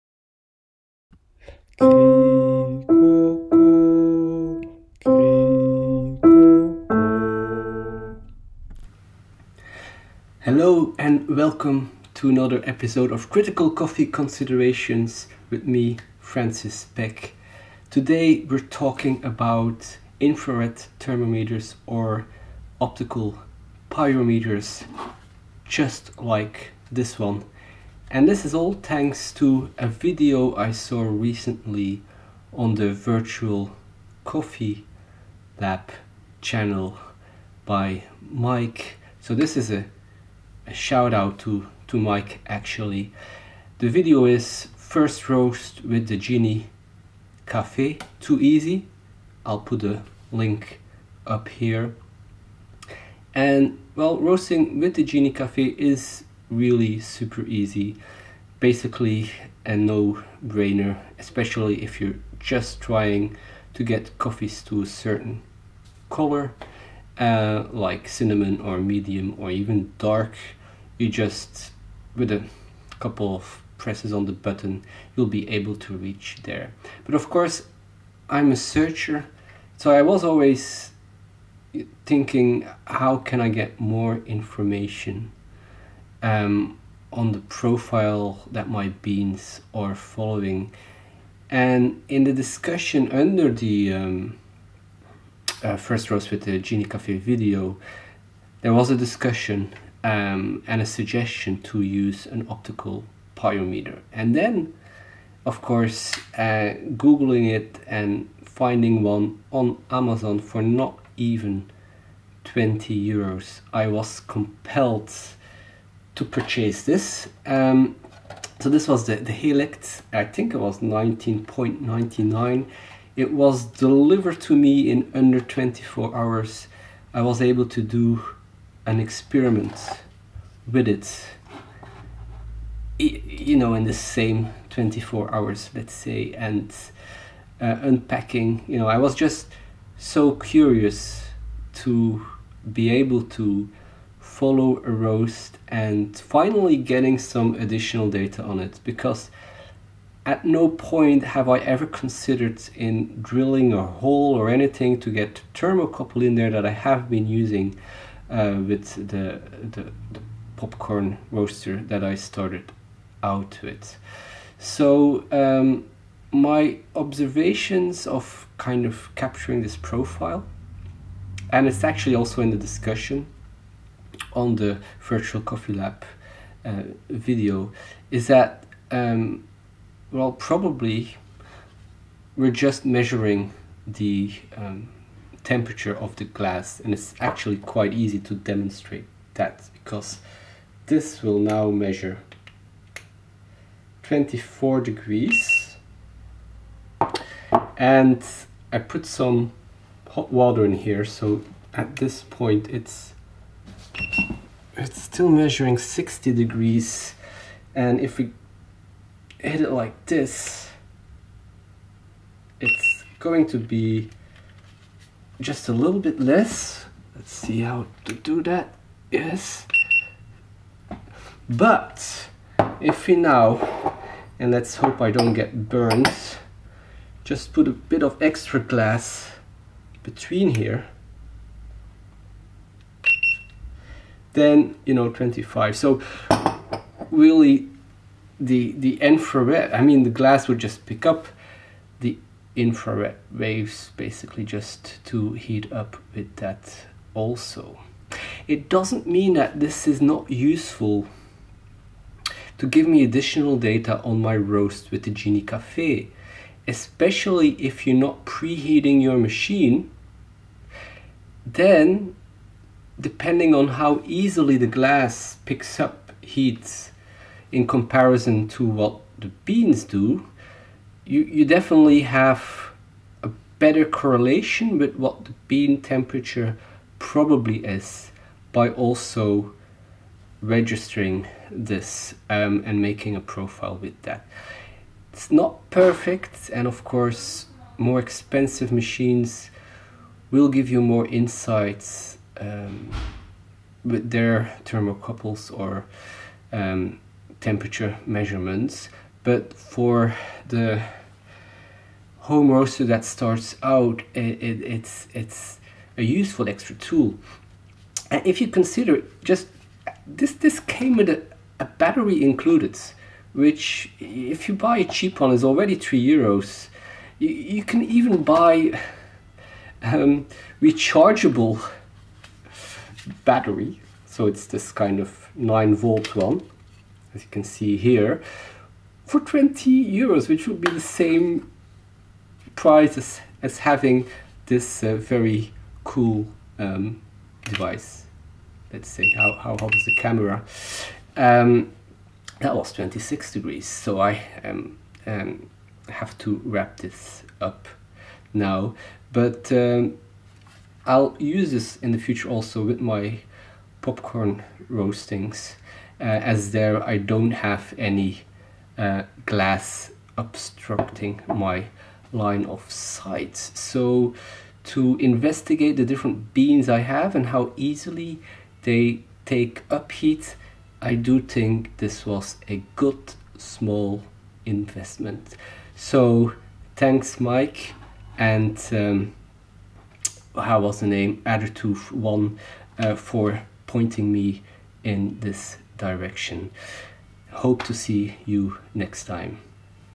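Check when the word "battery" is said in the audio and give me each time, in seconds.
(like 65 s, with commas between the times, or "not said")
311 s, 323 s.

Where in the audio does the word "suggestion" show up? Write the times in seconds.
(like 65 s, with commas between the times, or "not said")
100 s.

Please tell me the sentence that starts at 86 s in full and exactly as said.
um, on the profile that my beans are following.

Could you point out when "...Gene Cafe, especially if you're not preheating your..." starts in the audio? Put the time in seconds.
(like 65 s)
255 s.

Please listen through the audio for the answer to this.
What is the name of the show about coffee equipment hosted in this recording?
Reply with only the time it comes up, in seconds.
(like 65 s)
13 s.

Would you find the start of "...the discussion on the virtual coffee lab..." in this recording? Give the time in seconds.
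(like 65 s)
172 s.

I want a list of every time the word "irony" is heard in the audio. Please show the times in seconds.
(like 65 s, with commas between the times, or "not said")
not said.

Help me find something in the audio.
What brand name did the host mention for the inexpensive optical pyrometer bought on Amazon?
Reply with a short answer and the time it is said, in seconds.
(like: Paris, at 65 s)
Helix, at 119 s.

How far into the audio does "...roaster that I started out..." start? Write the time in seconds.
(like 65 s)
161 s.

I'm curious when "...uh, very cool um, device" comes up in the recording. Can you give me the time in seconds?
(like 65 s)
334 s.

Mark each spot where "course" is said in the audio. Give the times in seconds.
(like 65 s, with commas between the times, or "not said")
77 s, 105 s, 286 s.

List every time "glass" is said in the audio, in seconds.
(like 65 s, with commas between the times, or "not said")
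186 s, 228 s, 240 s, 264 s, 359 s.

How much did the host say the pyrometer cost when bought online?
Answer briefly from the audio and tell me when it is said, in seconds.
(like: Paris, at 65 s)
19.99 euros, at 120 s.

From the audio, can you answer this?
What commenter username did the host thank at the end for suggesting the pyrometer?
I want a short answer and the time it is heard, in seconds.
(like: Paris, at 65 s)
Addertooth1, at 381 s.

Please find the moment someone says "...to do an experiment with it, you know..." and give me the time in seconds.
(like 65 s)
127 s.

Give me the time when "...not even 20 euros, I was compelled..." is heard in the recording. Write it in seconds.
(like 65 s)
110 s.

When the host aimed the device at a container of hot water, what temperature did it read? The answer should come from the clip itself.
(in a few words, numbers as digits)
60 degrees.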